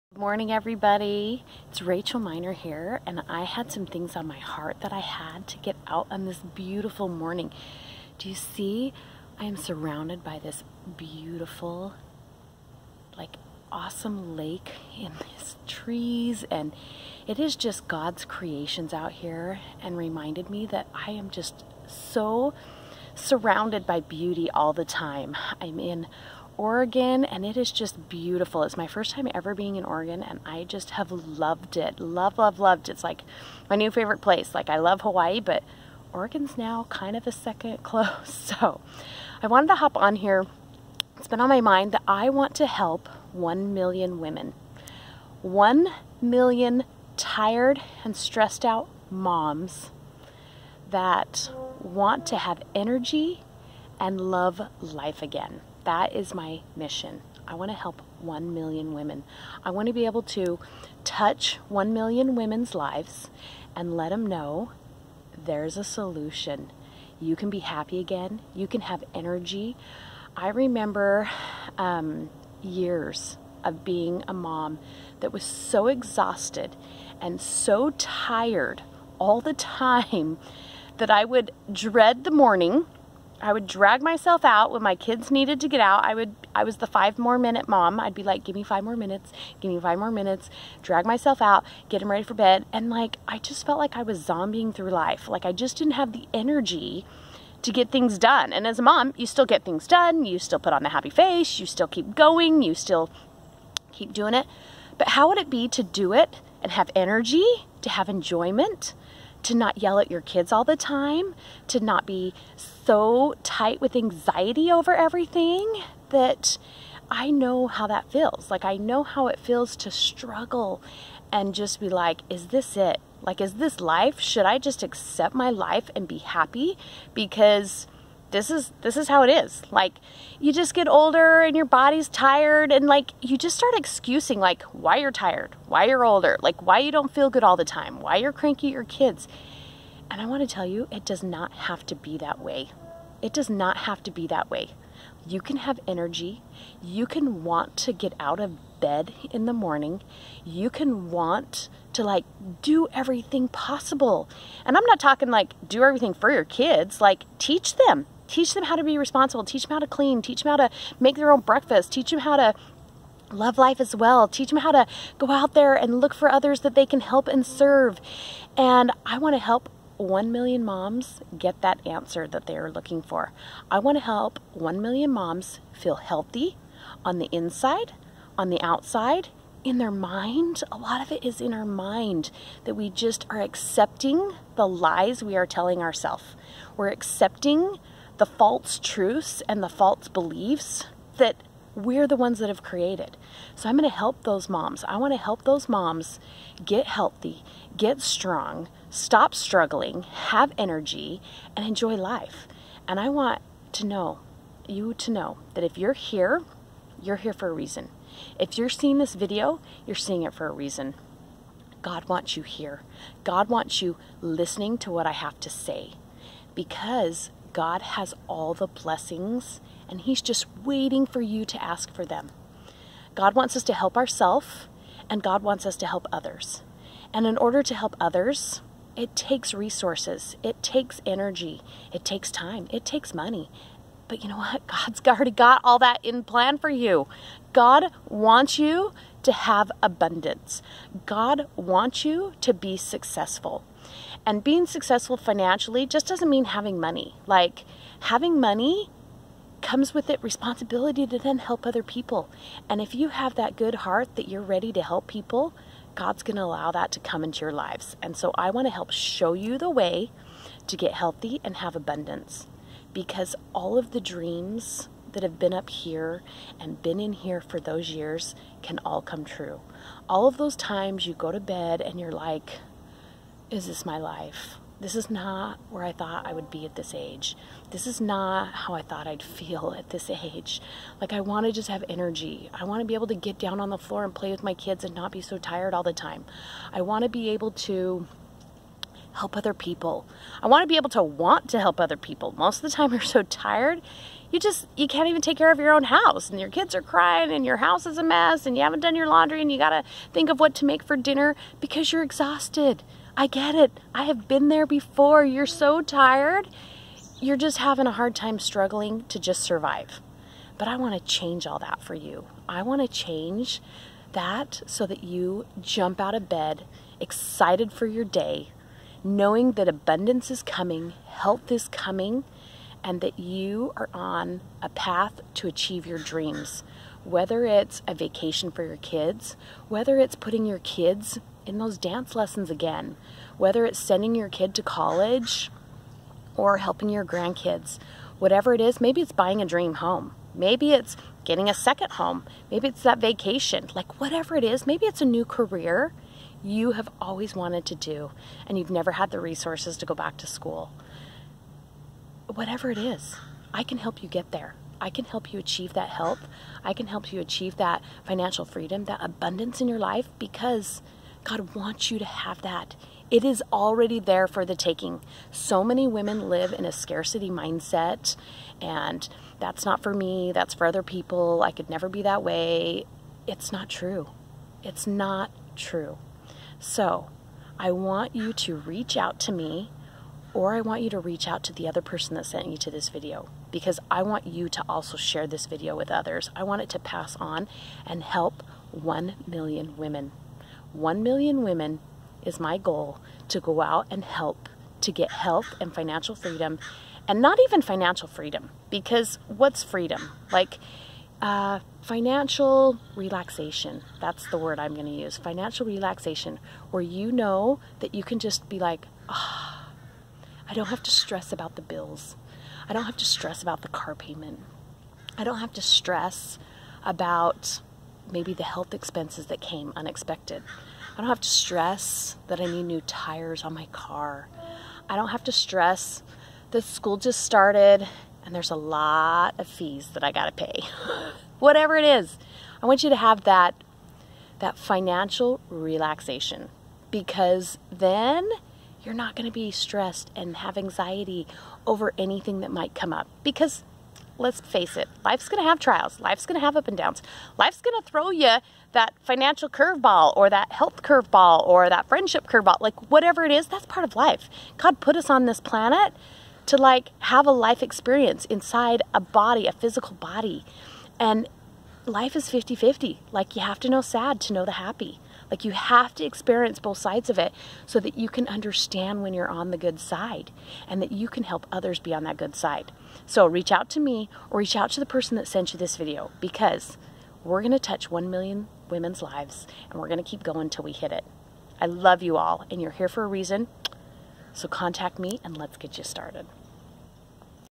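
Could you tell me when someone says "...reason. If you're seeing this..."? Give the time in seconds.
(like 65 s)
207 s.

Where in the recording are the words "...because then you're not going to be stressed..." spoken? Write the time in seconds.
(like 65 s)
436 s.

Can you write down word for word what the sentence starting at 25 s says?
I'm in Oregon and it is just beautiful.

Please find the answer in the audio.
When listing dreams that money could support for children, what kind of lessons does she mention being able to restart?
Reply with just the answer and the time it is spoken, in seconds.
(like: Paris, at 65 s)
dance lessons, at 331 s.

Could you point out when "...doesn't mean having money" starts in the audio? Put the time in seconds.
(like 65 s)
246 s.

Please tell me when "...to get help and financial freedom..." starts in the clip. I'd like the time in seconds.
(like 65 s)
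394 s.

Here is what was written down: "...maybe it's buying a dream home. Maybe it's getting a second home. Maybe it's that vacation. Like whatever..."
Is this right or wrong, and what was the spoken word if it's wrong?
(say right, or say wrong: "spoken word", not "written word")
right.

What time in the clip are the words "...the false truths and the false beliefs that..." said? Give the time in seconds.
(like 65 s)
188 s.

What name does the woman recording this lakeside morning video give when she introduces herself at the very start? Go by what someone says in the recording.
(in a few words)
Rachel Miner.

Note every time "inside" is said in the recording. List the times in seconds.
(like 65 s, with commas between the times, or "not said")
177 s, 458 s.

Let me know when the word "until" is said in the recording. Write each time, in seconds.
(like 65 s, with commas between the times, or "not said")
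480 s.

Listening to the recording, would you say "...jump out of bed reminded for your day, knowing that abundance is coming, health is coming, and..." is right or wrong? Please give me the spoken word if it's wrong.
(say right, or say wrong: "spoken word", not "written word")
wrong: "excited", not "reminded".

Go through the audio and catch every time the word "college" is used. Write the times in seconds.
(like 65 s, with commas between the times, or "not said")
334 s.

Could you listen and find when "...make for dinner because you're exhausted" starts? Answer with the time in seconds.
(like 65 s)
300 s.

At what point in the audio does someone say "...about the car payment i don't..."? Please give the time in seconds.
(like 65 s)
413 s.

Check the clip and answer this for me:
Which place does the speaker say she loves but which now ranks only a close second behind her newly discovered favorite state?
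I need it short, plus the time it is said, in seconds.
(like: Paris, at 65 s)
Hawaii, at 35 s.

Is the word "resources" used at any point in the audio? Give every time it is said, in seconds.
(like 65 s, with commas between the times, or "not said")
229 s, 349 s.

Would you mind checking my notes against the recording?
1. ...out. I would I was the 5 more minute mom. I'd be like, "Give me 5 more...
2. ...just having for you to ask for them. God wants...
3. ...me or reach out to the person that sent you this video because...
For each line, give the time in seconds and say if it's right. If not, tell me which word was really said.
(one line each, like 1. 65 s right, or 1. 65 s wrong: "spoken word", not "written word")
1. 85 s right
2. 220 s wrong: "waiting", not "having"
3. 473 s right.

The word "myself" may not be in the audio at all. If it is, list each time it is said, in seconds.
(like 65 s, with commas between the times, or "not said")
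84 s, 91 s.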